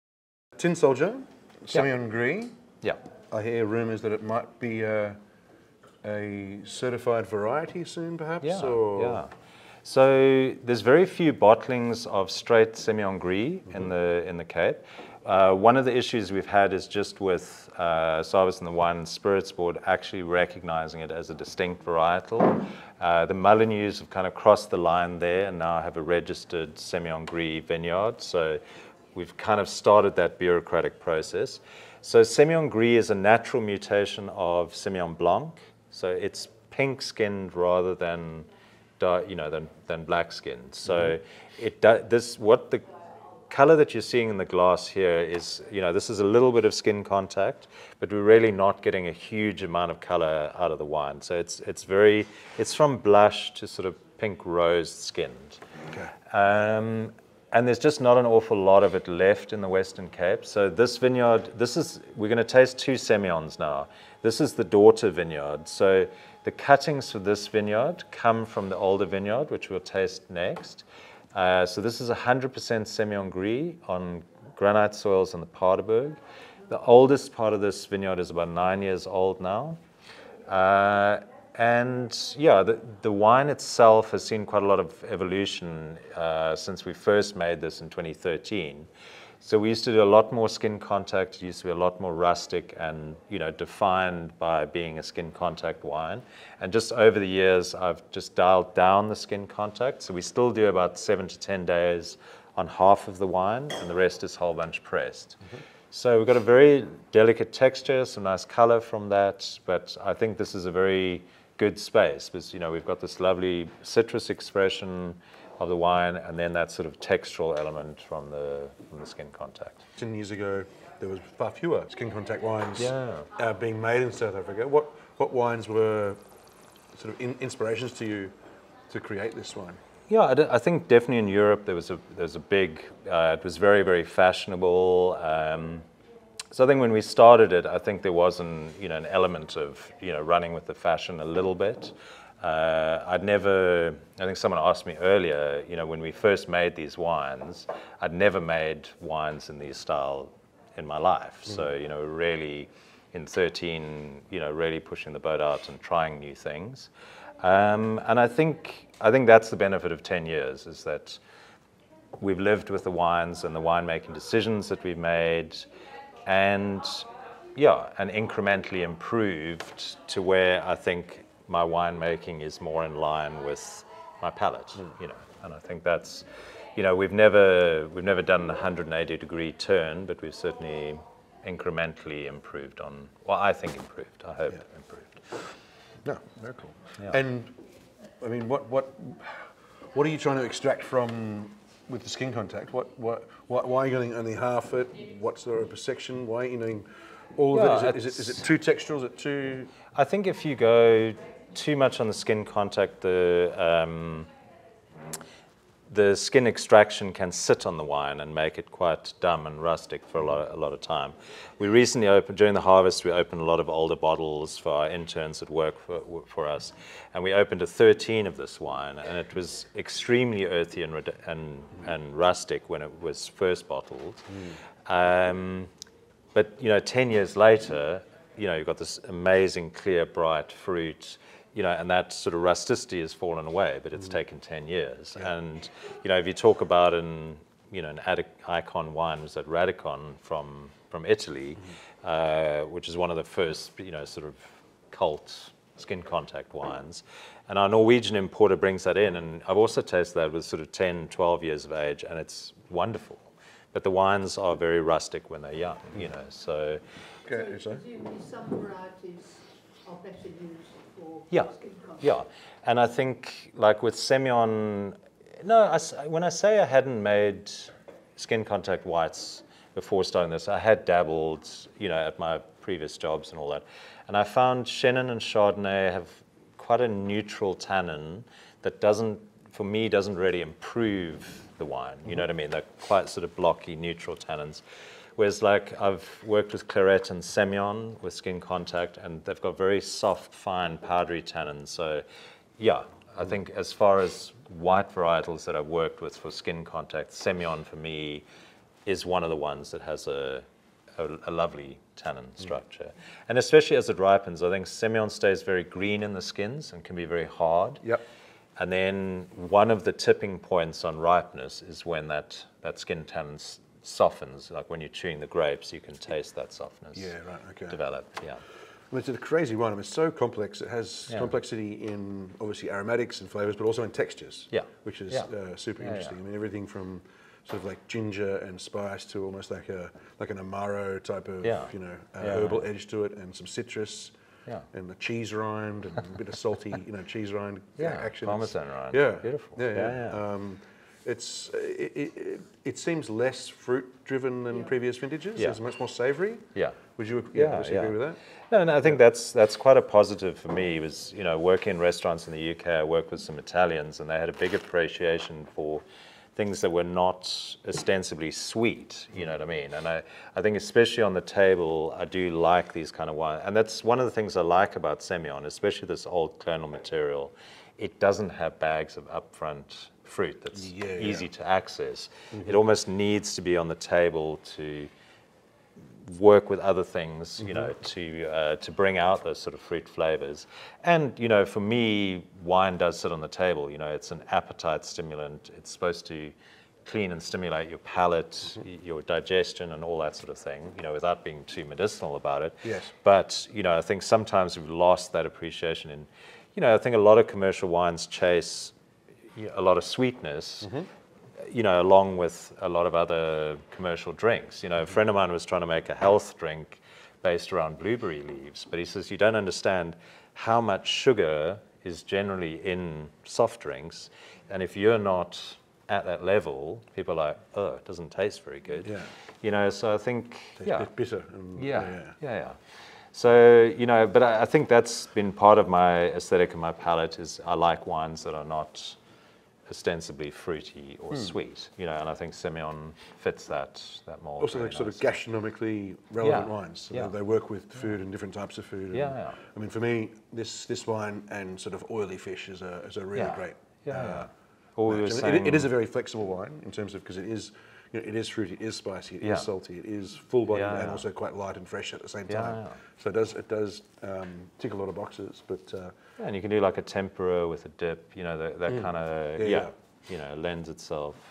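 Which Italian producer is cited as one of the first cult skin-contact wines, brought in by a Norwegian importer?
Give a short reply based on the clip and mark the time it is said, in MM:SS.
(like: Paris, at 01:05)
Radikon, at 03:59.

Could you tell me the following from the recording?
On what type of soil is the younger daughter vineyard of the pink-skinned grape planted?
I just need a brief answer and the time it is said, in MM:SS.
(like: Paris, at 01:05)
Granite, at 01:14.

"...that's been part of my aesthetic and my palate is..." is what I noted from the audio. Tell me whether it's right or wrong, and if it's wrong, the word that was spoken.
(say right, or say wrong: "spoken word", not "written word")
right.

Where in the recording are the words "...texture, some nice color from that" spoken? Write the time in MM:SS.
01:47.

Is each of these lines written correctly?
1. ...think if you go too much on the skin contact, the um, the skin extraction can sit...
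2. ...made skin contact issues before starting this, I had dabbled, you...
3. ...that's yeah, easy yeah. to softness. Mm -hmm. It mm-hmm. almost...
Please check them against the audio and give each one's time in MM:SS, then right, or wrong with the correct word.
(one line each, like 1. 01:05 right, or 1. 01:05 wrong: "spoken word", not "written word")
1. 03:20 right
2. 04:27 wrong: "whites", not "issues"
3. 06:10 wrong: "access", not "softness".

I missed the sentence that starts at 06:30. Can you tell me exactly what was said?
You know, without being too medicinal about it.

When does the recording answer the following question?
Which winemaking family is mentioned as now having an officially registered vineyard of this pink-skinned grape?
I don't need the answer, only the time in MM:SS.
00:23.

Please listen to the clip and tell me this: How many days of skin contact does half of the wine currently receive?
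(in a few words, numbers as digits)
7 to 10 days.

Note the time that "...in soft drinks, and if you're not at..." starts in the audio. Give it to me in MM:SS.
06:52.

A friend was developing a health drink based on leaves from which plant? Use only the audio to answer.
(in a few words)
Blueberry.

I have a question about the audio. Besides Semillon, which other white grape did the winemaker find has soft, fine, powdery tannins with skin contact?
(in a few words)
Clairette.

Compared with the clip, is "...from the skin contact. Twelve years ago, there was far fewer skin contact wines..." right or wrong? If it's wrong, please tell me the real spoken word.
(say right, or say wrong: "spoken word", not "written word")
wrong: "Ten", not "Twelve".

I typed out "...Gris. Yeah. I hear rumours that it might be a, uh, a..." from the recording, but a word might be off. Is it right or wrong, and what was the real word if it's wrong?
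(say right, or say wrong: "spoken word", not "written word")
right.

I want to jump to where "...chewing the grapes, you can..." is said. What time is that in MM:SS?
05:14.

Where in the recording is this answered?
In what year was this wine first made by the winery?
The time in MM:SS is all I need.
01:27.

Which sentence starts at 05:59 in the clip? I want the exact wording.
And I, I think especially on the table, I do like these kind of wines.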